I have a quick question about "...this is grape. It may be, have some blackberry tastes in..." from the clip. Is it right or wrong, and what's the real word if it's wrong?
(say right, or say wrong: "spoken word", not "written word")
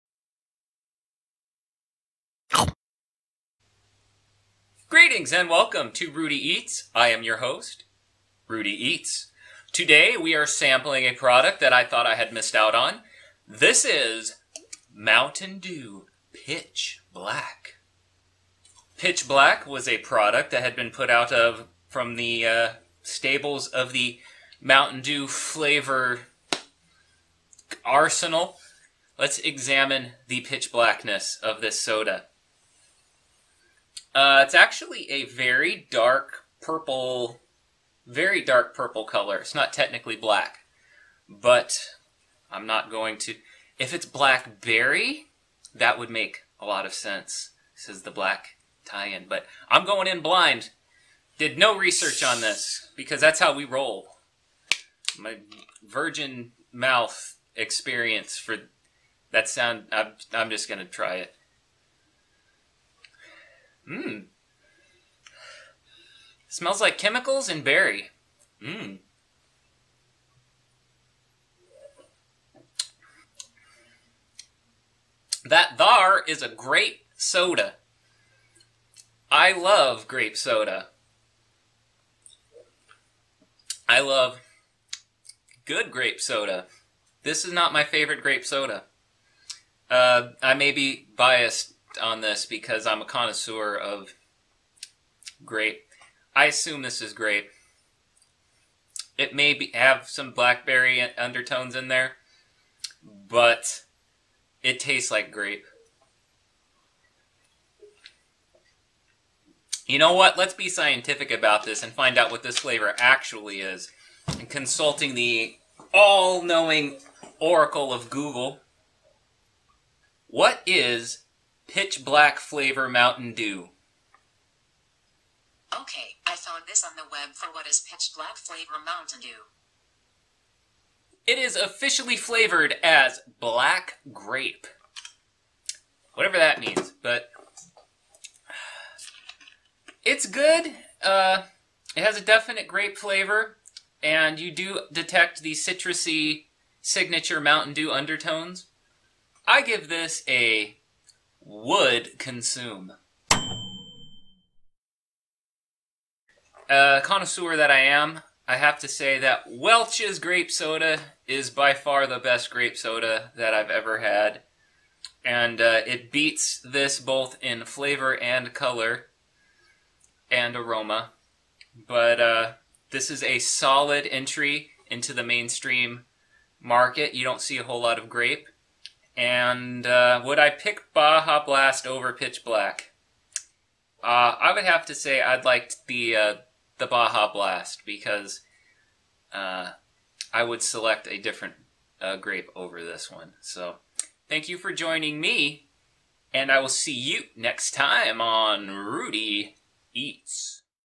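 wrong: "undertones", not "tastes".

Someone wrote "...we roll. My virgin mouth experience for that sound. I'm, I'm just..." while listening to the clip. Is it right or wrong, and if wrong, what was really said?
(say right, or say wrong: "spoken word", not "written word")
right.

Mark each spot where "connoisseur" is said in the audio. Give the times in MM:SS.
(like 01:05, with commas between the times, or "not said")
01:33, 02:37.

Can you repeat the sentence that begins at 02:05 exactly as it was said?
Okay, I found this on the web for what is Pitch Black Flavor Mountain Dew.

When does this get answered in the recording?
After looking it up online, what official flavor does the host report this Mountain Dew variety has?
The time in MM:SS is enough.
02:13.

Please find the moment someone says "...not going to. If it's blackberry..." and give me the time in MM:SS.
00:42.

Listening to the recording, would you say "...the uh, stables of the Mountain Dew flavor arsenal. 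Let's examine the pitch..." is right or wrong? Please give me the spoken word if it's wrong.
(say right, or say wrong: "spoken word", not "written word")
right.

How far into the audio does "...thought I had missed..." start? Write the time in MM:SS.
00:11.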